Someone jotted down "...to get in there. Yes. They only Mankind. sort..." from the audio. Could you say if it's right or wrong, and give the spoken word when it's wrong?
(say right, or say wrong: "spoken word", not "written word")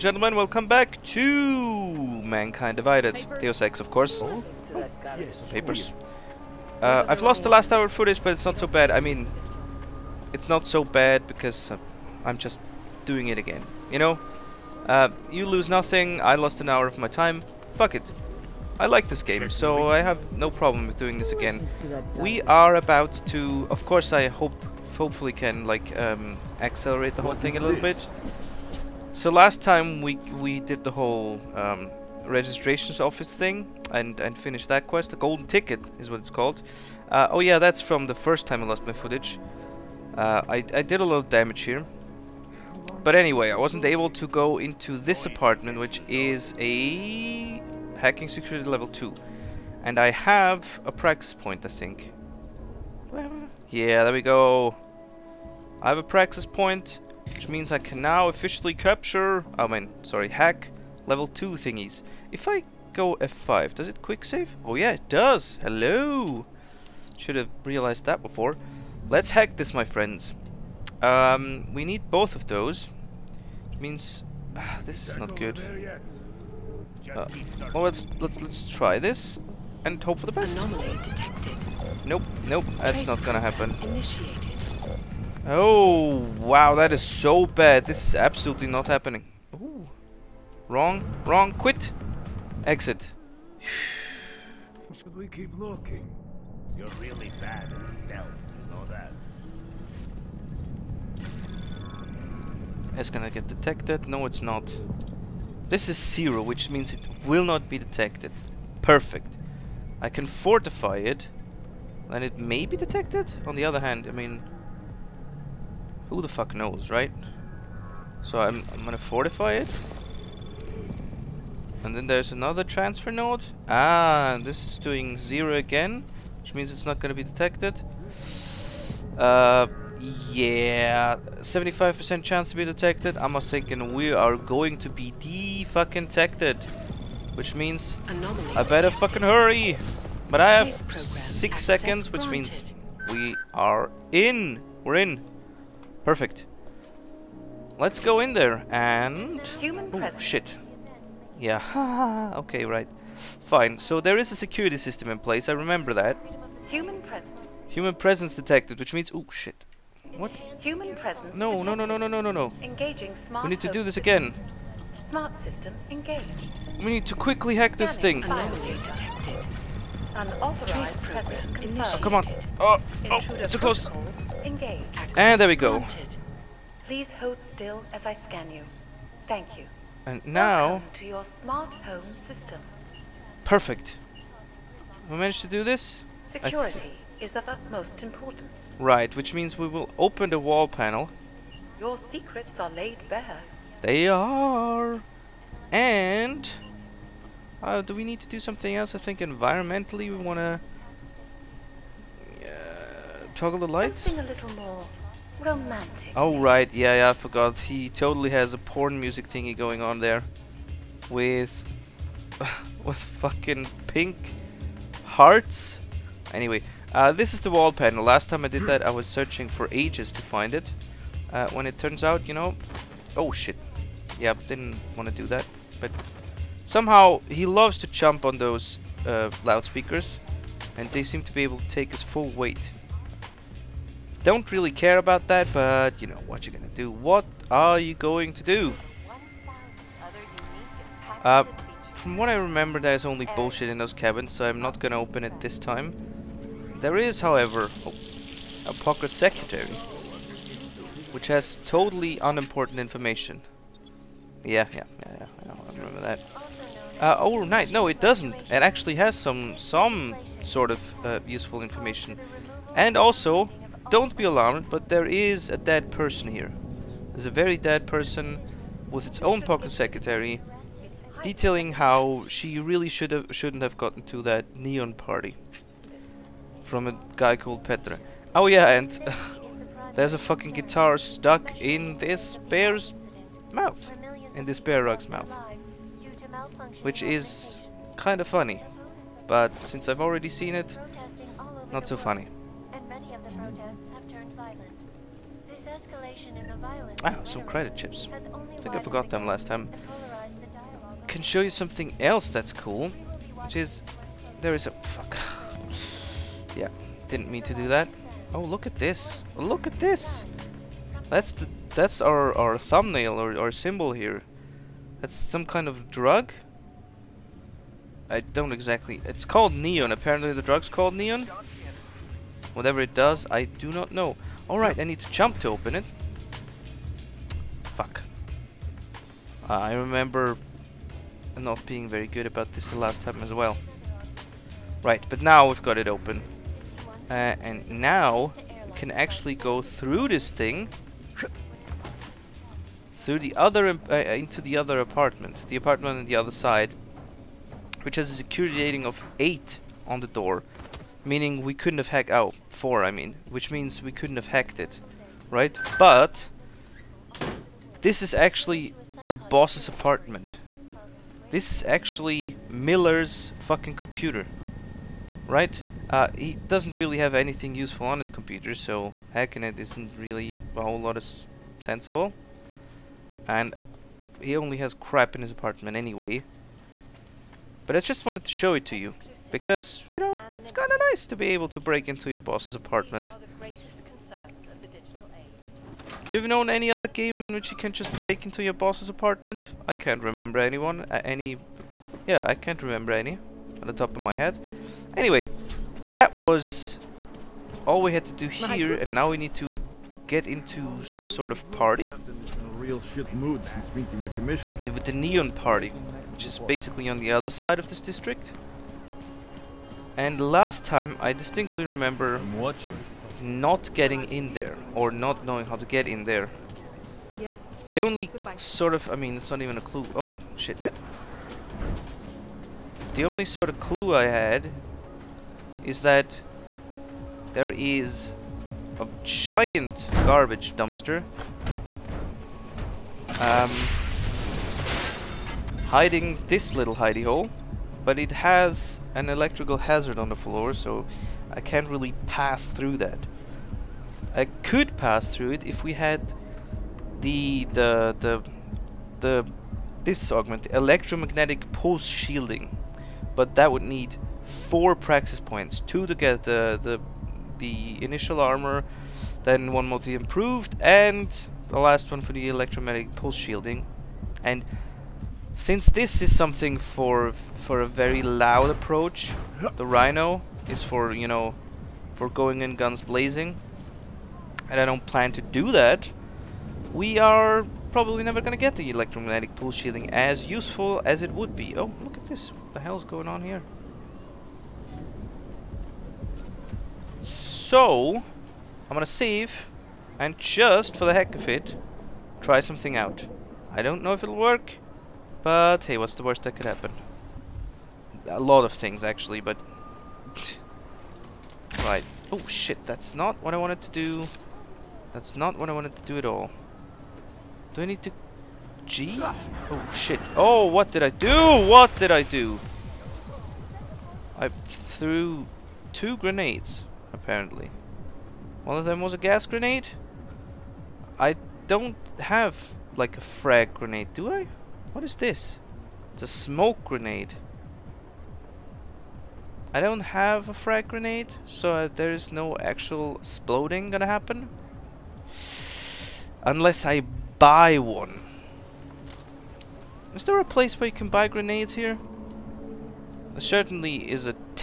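wrong: "Goodbye", not "Mankind".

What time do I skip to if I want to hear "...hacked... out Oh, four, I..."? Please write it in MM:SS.
05:51.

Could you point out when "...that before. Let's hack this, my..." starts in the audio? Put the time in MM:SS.
01:08.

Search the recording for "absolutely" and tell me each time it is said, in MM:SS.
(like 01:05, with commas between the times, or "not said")
01:28.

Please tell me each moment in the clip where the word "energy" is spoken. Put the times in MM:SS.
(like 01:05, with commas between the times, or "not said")
not said.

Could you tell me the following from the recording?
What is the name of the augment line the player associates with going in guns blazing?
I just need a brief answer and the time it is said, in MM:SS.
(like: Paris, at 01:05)
Rhino, at 07:49.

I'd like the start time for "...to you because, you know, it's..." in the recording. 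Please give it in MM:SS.
06:18.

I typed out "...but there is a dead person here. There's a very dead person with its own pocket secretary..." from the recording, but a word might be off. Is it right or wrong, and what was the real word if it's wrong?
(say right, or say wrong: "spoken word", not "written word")
right.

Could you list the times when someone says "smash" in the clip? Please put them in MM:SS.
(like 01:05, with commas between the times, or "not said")
not said.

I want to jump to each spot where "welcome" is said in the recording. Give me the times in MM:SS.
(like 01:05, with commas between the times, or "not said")
00:00, 03:00.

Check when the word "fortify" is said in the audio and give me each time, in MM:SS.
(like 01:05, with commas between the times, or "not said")
01:50, 01:58.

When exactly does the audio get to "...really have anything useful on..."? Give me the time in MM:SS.
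06:06.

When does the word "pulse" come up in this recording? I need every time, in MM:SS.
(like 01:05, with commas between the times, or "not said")
07:31, 07:42, 07:59.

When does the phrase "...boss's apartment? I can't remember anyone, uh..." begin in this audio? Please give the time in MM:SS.
06:28.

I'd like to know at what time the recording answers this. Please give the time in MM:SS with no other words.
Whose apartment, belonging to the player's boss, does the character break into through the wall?
06:02.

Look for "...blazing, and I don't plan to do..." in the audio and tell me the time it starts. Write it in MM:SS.
07:52.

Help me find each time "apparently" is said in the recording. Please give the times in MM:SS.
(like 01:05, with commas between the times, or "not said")
05:19, 08:36.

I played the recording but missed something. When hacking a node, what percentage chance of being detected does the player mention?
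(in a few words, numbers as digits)
75%.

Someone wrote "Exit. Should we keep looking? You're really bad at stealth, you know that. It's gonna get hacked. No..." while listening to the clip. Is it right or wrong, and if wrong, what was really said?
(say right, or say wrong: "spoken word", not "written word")
wrong: "detected", not "hacked".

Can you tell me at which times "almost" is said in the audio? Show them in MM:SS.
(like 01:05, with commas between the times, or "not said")
not said.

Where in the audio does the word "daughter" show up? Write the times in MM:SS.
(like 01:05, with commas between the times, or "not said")
not said.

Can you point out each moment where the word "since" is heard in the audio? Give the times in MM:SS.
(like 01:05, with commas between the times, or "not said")
04:49, 06:43, 07:45.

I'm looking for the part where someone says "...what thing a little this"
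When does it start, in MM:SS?
00:27.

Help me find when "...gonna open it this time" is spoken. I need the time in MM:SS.
04:04.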